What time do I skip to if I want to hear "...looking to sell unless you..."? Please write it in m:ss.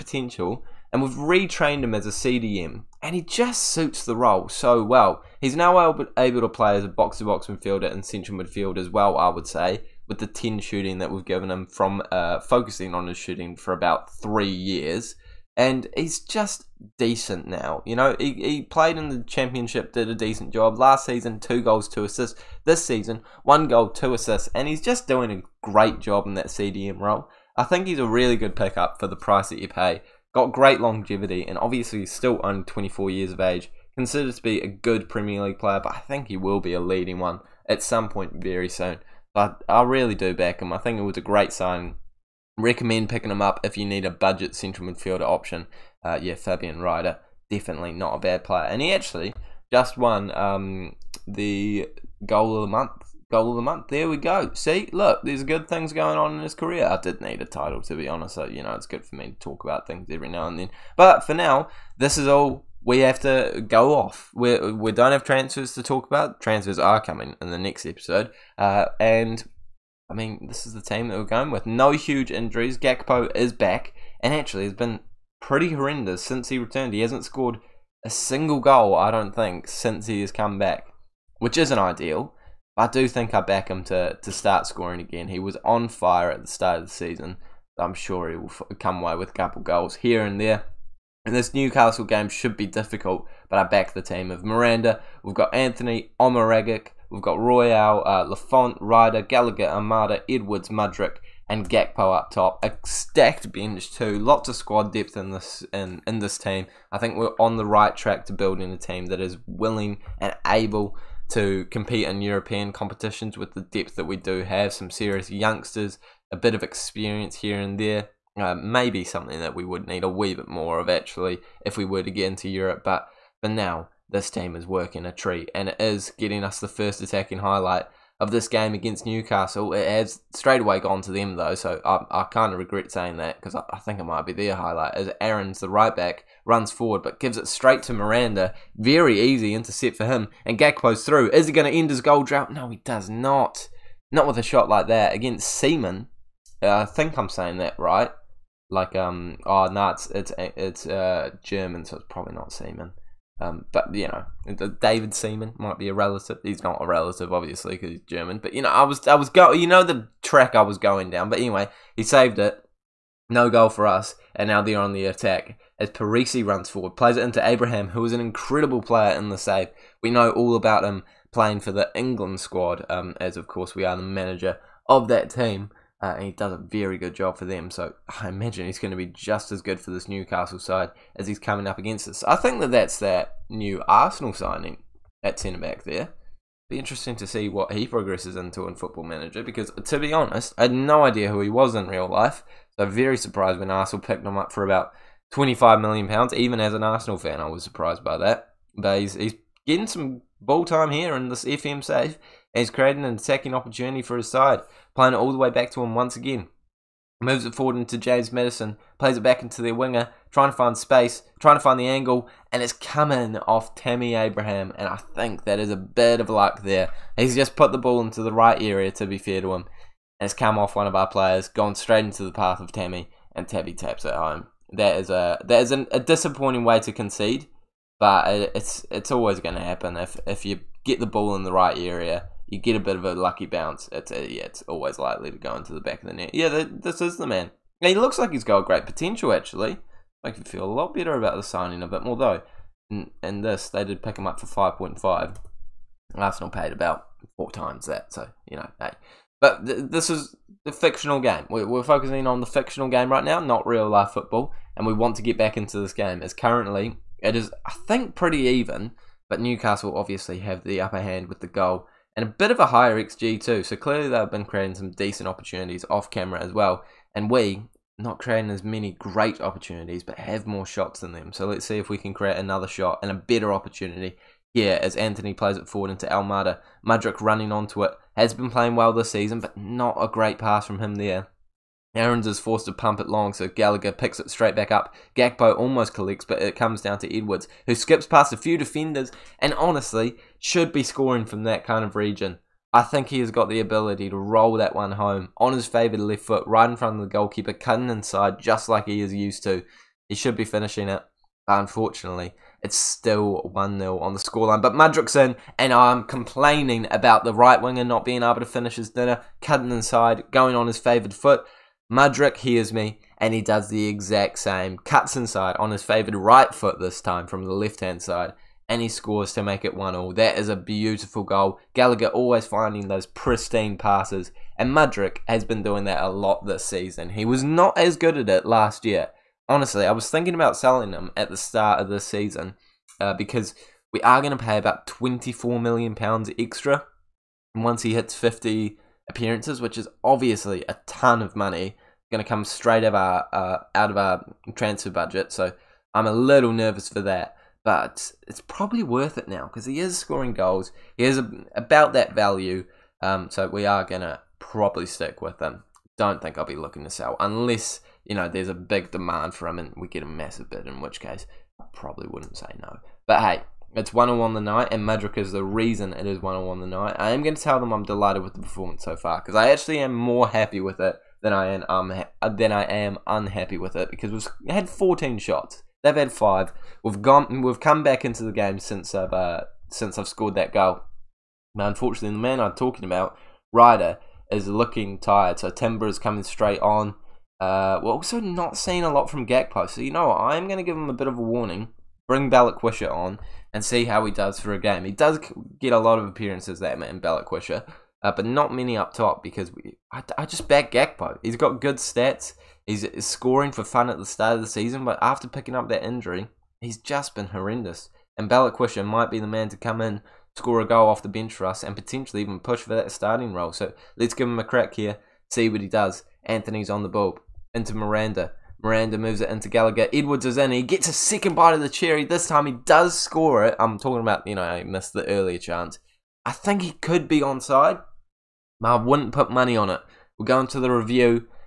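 5:56.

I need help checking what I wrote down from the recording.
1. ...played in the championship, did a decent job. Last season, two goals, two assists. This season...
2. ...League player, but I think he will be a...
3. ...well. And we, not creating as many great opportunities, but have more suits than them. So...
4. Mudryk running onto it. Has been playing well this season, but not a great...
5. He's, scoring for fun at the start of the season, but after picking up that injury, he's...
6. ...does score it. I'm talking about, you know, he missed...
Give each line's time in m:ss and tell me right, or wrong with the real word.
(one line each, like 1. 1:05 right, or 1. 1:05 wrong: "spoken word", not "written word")
1. 0:18 right
2. 0:35 right
3. 4:26 wrong: "shots", not "suits"
4. 4:36 right
5. 6:42 right
6. 7:02 right.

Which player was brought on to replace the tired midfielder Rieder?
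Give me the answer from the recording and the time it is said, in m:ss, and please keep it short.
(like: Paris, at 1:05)
Timber, at 6:25.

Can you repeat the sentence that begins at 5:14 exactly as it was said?
Cuts inside on his favoured right foot this time from the left hand side and he scores to make it 1 all.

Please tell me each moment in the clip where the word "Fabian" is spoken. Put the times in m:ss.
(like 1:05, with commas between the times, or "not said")
0:46.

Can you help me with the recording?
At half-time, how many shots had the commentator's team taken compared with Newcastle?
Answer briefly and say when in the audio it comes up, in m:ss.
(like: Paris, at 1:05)
14, at 6:14.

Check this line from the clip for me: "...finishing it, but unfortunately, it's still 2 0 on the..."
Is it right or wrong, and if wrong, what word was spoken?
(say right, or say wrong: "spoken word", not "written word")
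wrong: "1", not "2".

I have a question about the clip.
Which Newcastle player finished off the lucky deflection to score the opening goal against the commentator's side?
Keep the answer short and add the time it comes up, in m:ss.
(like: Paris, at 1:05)
Tammy Abraham, at 3:43.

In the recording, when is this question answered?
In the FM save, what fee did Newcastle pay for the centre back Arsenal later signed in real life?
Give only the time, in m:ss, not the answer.
4:04.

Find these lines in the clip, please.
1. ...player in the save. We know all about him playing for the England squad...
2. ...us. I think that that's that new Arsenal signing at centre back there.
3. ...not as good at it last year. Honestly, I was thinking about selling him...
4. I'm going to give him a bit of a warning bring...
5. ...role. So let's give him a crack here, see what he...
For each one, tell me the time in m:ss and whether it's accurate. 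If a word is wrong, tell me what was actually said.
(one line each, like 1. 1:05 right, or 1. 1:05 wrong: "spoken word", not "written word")
1. 2:48 right
2. 3:02 right
3. 5:27 right
4. 6:30 right
5. 6:53 right.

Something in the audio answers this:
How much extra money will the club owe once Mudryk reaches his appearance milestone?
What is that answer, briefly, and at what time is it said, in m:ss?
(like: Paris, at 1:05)
£24 million, at 5:34.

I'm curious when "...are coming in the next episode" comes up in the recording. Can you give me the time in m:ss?
1:06.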